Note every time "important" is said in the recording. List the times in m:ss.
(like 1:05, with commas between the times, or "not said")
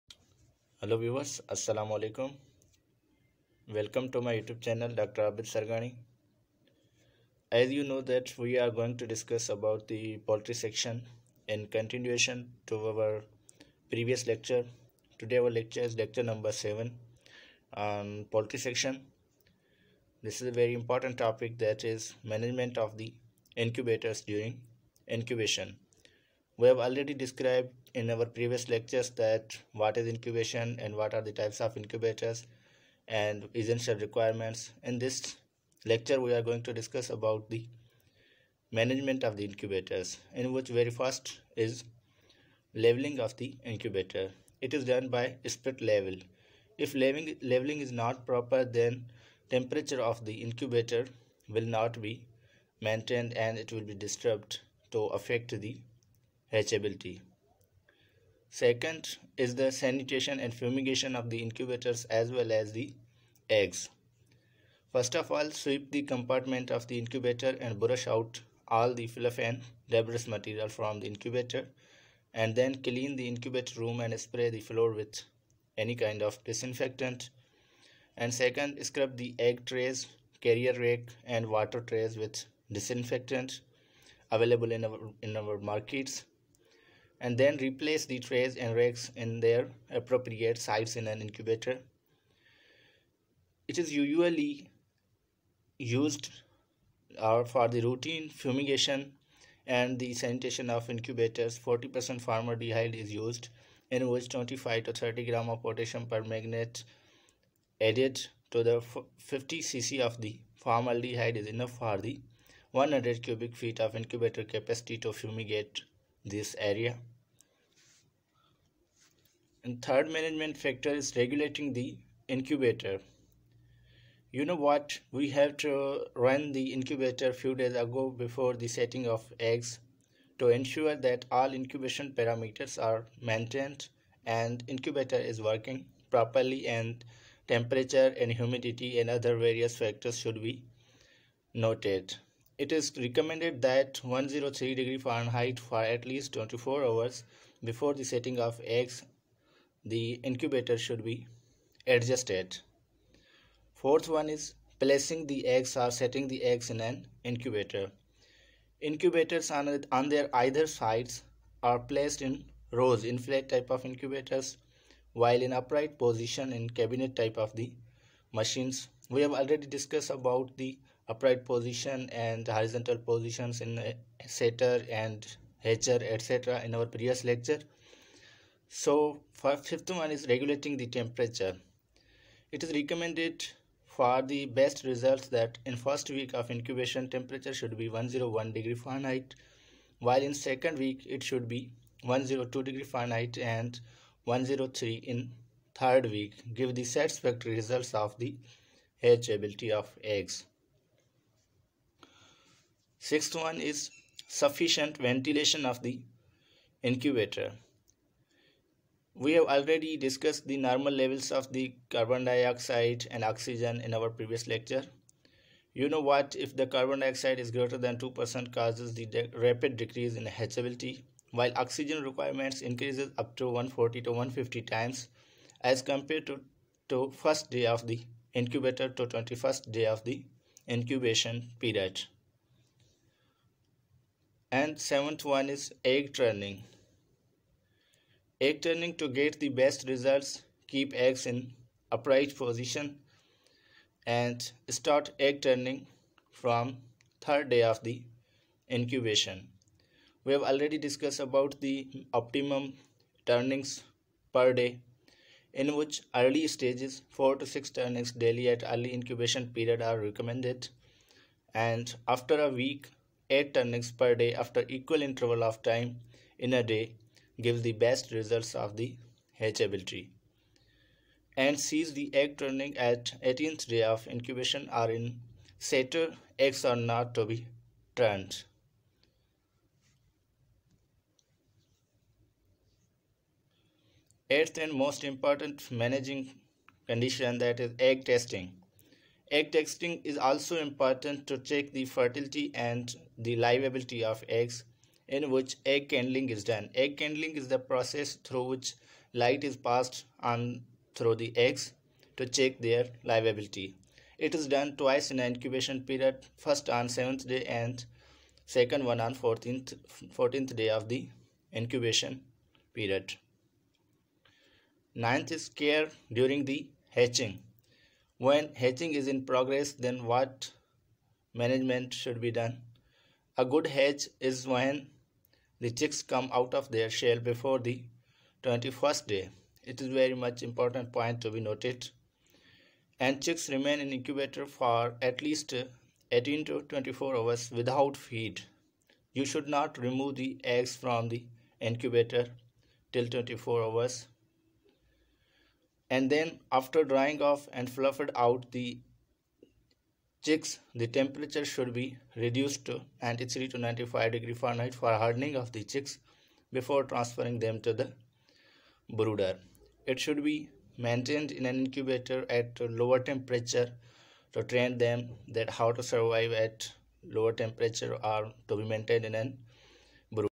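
0:20, 4:45, 4:50, 5:30.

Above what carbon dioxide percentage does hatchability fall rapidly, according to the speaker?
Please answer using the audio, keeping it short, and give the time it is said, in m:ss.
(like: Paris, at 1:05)
2%, at 3:37.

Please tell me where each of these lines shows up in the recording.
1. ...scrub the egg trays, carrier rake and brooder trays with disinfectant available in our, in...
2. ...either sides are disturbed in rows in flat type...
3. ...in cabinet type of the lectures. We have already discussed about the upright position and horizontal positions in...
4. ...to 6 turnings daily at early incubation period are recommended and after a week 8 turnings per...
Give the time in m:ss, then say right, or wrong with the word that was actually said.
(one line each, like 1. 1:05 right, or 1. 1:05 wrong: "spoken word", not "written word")
1. 1:18 wrong: "water", not "brooder"
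2. 2:40 wrong: "placed", not "disturbed"
3. 2:46 wrong: "machines", not "lectures"
4. 4:17 right.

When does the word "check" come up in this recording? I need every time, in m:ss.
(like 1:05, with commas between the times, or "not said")
4:51, 5:02.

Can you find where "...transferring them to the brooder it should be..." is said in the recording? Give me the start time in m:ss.
5:56.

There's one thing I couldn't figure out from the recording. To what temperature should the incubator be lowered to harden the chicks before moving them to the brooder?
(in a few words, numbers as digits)
93 to 95 degrees Fahrenheit.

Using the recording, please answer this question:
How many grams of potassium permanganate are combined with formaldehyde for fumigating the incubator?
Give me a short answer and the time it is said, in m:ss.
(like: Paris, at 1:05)
25 to 30 grams, at 1:44.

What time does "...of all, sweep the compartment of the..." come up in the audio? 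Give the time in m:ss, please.
1:05.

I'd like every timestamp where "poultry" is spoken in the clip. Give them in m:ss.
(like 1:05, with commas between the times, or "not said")
0:10, 0:18.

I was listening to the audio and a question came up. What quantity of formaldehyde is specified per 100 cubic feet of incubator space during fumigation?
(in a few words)
50 cc.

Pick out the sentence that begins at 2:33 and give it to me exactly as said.
Fourth one is placing the eggs or setting the eggs in an incubator.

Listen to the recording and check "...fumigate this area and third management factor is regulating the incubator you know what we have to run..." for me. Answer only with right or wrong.
right.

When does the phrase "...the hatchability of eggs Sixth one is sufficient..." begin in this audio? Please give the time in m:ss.
3:18.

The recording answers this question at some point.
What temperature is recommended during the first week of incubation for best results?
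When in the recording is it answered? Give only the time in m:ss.
3:07.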